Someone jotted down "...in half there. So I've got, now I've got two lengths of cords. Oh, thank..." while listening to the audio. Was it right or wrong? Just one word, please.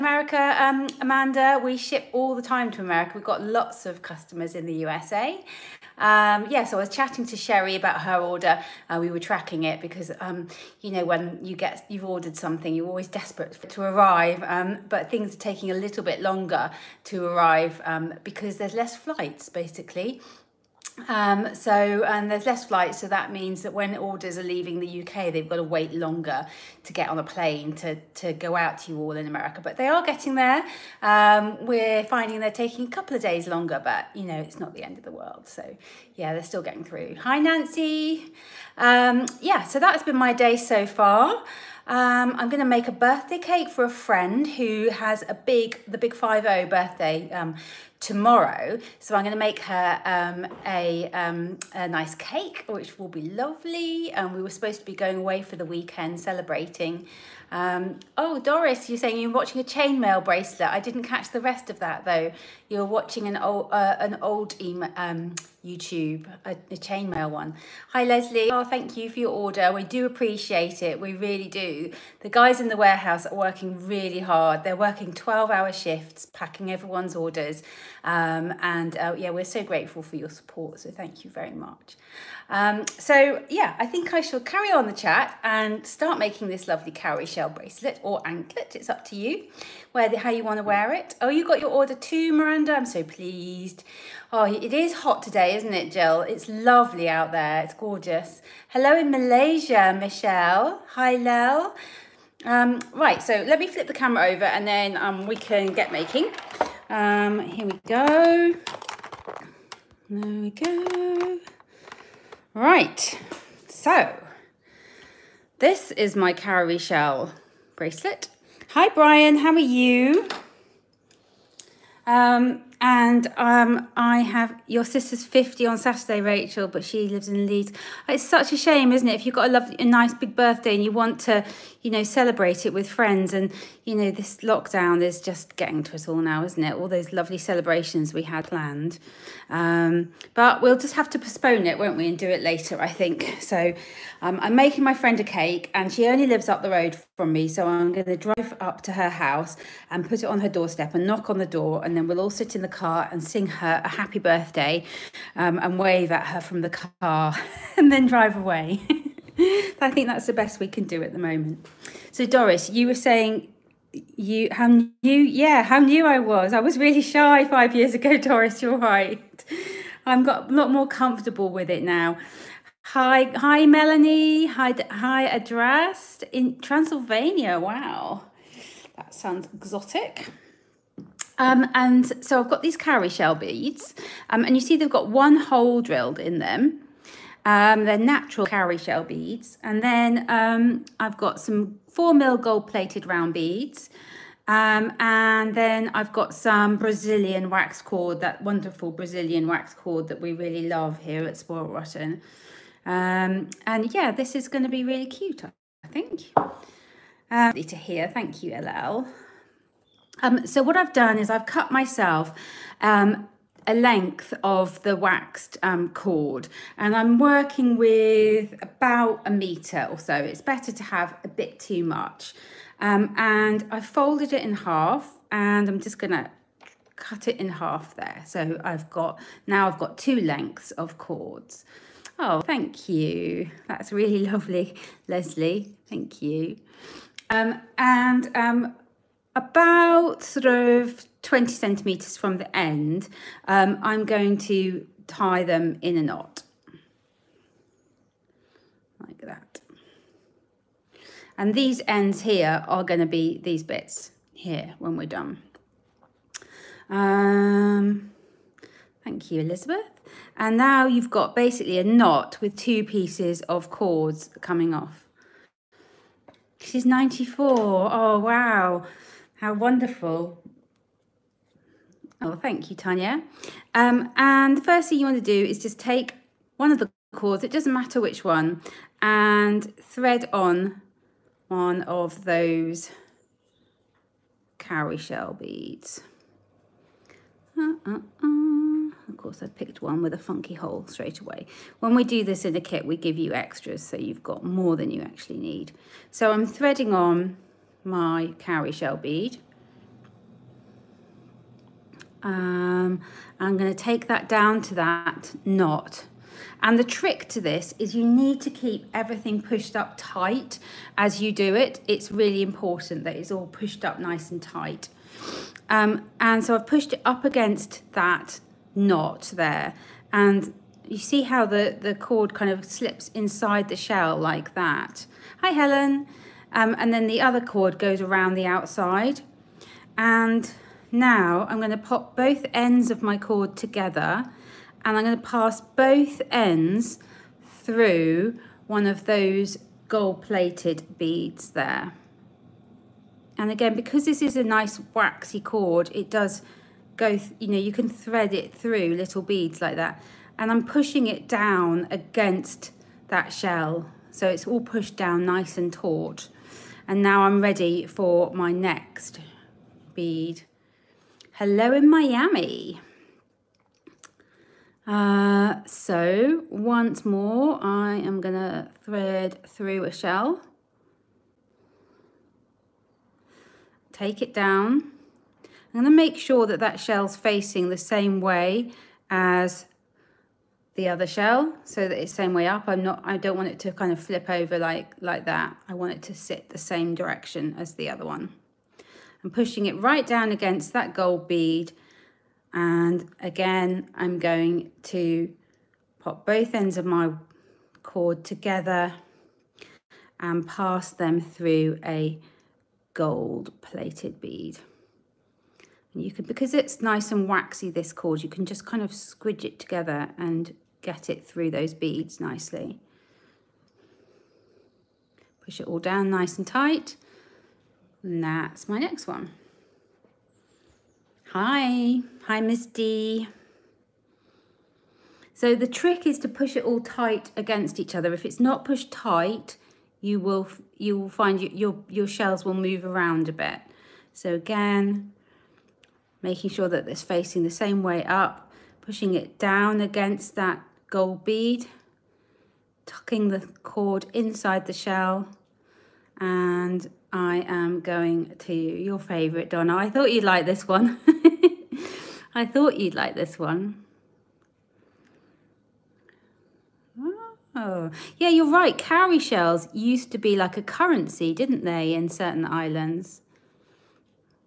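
right.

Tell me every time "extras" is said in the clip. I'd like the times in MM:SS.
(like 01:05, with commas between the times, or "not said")
04:53.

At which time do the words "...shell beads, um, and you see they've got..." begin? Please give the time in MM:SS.
03:03.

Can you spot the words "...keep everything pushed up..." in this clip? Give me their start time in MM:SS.
05:08.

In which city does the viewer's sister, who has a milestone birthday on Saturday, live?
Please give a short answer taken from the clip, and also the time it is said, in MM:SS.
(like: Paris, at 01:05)
Leeds, at 02:07.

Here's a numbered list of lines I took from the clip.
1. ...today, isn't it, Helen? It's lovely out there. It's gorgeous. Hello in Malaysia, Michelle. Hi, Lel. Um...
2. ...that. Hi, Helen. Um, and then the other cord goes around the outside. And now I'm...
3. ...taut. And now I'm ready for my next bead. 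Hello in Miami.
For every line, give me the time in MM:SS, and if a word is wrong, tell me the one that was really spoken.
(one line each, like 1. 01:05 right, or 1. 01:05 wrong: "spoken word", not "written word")
1. 01:35 wrong: "Jill", not "Helen"
2. 05:24 right
3. 05:55 right.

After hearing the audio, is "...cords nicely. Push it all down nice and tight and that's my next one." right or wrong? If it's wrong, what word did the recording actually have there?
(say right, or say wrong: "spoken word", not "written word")
wrong: "beads", not "cords".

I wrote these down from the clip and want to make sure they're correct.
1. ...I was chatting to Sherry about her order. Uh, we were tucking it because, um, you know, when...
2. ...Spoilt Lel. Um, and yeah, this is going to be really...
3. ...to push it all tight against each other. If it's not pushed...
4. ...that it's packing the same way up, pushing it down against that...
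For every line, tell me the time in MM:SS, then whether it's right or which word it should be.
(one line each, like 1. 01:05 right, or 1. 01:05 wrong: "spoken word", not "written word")
1. 00:06 wrong: "tracking", not "tucking"
2. 03:21 wrong: "Rotten", not "Lel"
3. 07:06 right
4. 07:16 wrong: "facing", not "packing".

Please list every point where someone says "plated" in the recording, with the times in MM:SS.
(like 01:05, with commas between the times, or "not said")
03:12, 05:39, 06:43.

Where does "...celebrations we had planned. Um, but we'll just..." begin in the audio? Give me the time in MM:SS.
02:17.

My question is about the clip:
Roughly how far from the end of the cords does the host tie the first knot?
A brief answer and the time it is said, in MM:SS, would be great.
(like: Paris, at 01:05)
20 centimetres, at 04:01.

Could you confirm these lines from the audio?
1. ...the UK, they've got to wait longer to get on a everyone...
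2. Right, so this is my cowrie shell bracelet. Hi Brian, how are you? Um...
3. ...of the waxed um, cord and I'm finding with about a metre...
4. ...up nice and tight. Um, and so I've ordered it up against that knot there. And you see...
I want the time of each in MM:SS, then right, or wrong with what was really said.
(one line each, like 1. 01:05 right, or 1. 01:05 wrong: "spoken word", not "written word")
1. 00:24 wrong: "plane", not "everyone"
2. 01:52 right
3. 03:34 wrong: "working", not "finding"
4. 05:13 wrong: "pushed", not "ordered".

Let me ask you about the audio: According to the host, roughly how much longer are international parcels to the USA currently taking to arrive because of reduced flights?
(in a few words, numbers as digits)
a couple of days.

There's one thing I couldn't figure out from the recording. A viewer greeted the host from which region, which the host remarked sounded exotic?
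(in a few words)
Transylvania.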